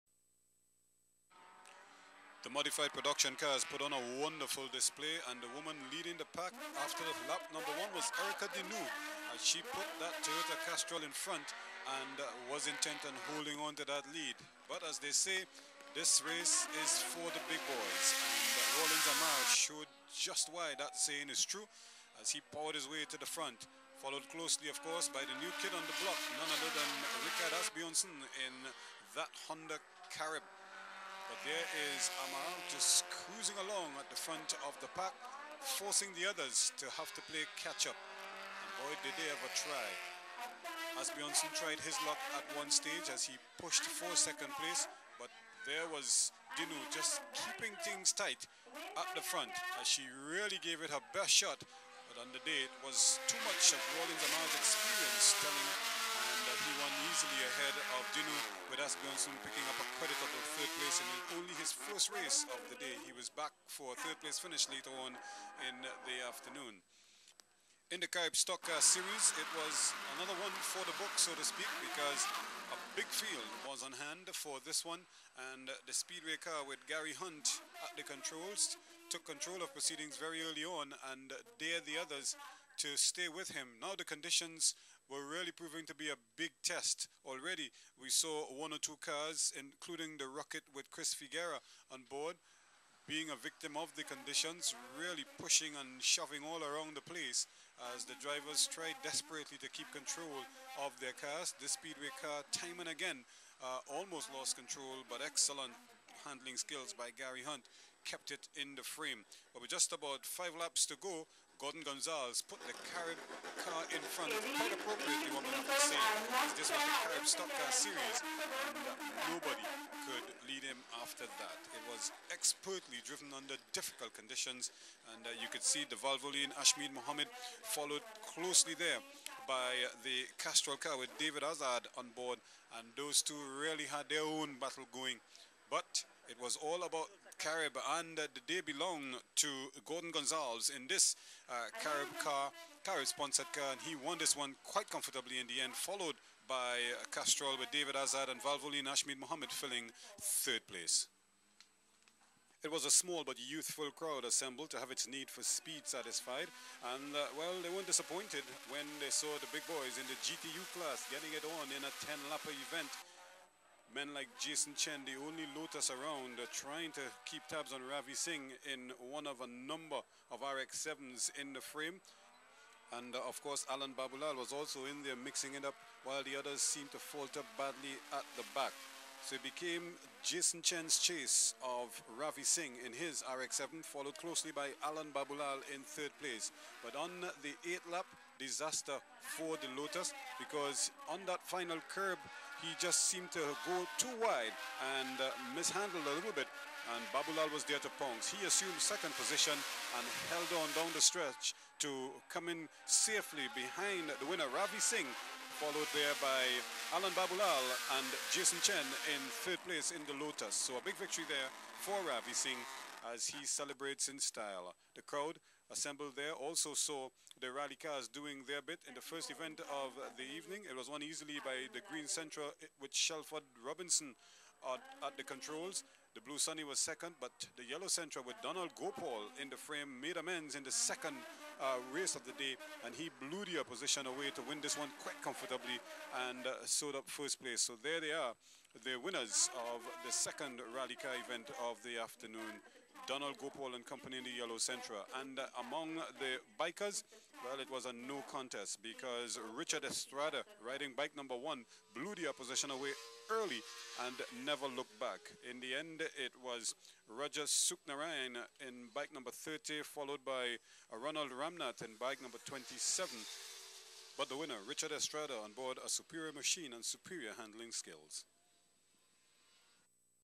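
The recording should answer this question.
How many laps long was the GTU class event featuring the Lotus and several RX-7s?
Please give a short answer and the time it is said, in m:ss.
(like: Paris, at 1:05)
10, at 2:42.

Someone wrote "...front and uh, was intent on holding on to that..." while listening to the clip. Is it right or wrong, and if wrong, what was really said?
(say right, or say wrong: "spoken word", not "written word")
right.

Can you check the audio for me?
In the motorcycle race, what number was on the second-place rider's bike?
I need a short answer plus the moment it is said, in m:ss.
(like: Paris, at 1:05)
30, at 4:18.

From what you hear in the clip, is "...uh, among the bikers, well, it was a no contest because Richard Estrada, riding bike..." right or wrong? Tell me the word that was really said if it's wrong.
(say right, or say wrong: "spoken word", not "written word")
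right.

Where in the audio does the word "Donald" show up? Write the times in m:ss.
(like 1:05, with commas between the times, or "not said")
3:48, 4:03.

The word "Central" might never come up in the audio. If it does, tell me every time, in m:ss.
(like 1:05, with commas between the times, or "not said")
3:42, 3:47, 4:04.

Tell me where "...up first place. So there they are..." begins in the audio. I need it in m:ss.
3:56.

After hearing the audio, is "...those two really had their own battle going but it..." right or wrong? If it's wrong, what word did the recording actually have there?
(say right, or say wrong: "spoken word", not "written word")
right.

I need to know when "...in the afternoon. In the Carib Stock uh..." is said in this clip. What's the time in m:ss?
1:05.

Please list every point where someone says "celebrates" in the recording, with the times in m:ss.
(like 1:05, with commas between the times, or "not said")
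3:33.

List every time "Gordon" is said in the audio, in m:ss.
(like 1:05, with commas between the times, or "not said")
1:51, 2:19.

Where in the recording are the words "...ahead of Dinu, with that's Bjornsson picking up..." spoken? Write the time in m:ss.
0:57.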